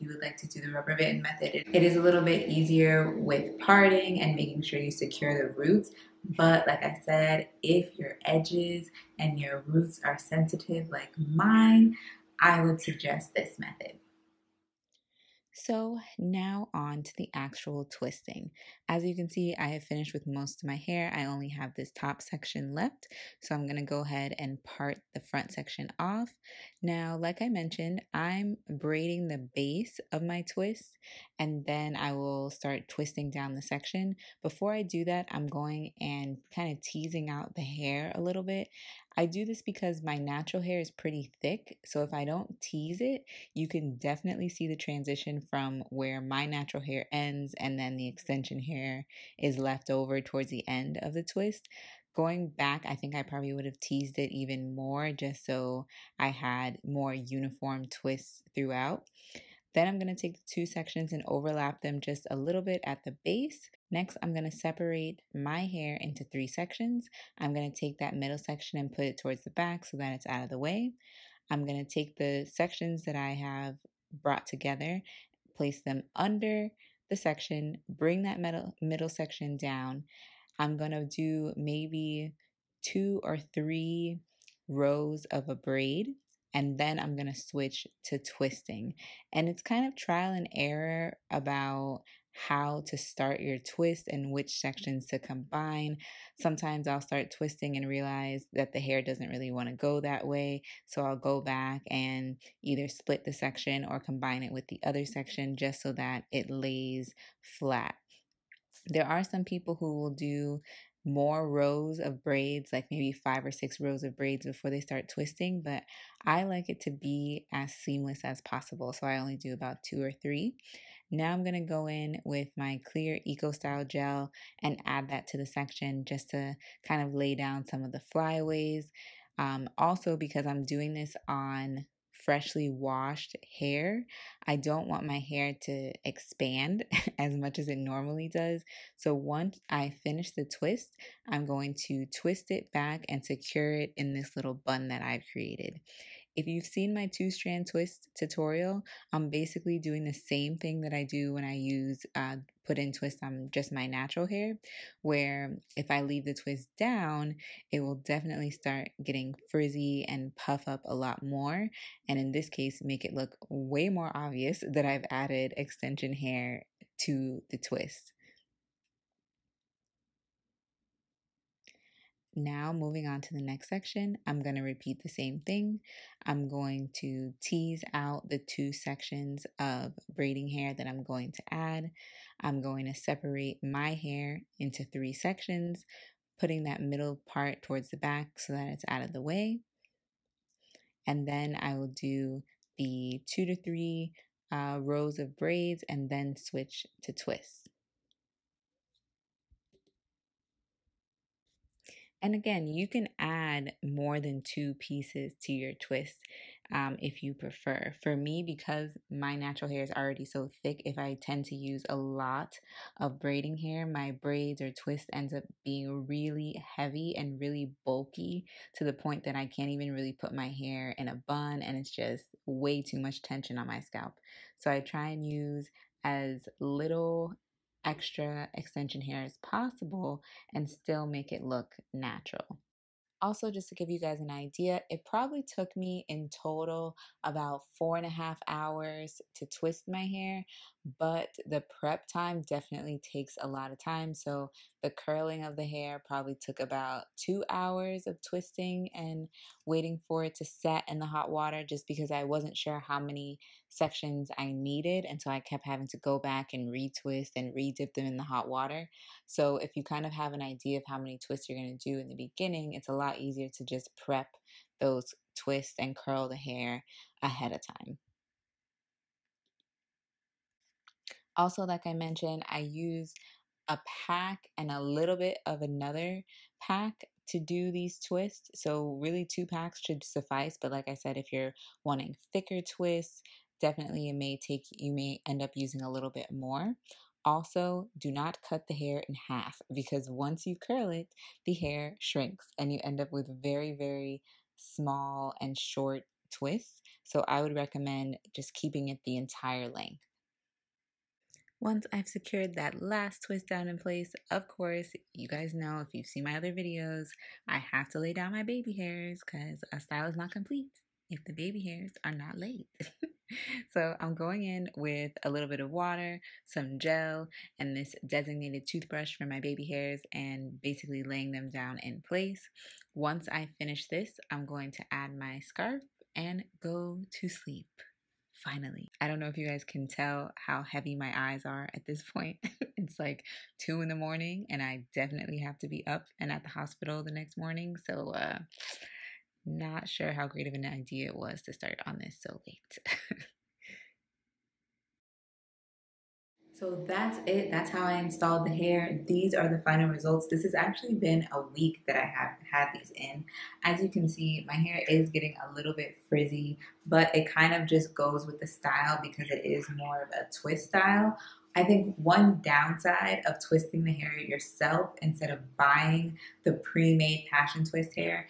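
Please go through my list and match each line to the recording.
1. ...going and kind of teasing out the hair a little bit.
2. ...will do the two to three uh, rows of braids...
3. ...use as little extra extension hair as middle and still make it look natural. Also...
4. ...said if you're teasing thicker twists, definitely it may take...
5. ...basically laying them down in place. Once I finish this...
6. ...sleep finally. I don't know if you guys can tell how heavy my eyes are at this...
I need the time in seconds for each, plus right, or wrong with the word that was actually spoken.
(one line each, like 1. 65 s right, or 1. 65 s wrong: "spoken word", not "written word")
1. 35 s right
2. 191 s right
3. 225 s wrong: "possible", not "middle"
4. 280 s wrong: "wanting", not "teasing"
5. 320 s right
6. 327 s right.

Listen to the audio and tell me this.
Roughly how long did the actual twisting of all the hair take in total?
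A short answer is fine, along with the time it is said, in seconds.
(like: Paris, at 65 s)
4.5 hours, at 237 s.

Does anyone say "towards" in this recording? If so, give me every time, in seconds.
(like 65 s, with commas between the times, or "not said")
50 s, 69 s, 187 s.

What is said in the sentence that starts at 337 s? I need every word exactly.
So, uh, not sure how great of an idea it was to start on this so late.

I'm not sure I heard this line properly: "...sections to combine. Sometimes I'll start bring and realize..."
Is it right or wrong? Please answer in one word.
wrong.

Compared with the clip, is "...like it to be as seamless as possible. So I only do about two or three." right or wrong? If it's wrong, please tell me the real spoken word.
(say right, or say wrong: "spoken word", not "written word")
right.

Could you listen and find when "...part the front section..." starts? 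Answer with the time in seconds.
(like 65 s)
24 s.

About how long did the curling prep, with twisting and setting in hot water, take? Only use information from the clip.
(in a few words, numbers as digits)
2 hours.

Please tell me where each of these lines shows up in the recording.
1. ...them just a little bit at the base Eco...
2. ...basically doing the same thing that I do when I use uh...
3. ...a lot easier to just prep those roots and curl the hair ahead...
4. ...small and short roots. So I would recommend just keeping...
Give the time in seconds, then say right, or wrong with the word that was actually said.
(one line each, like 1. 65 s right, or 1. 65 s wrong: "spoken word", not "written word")
1. 61 s wrong: "Next", not "Eco"
2. 149 s right
3. 262 s wrong: "twists", not "roots"
4. 294 s wrong: "twists", not "roots".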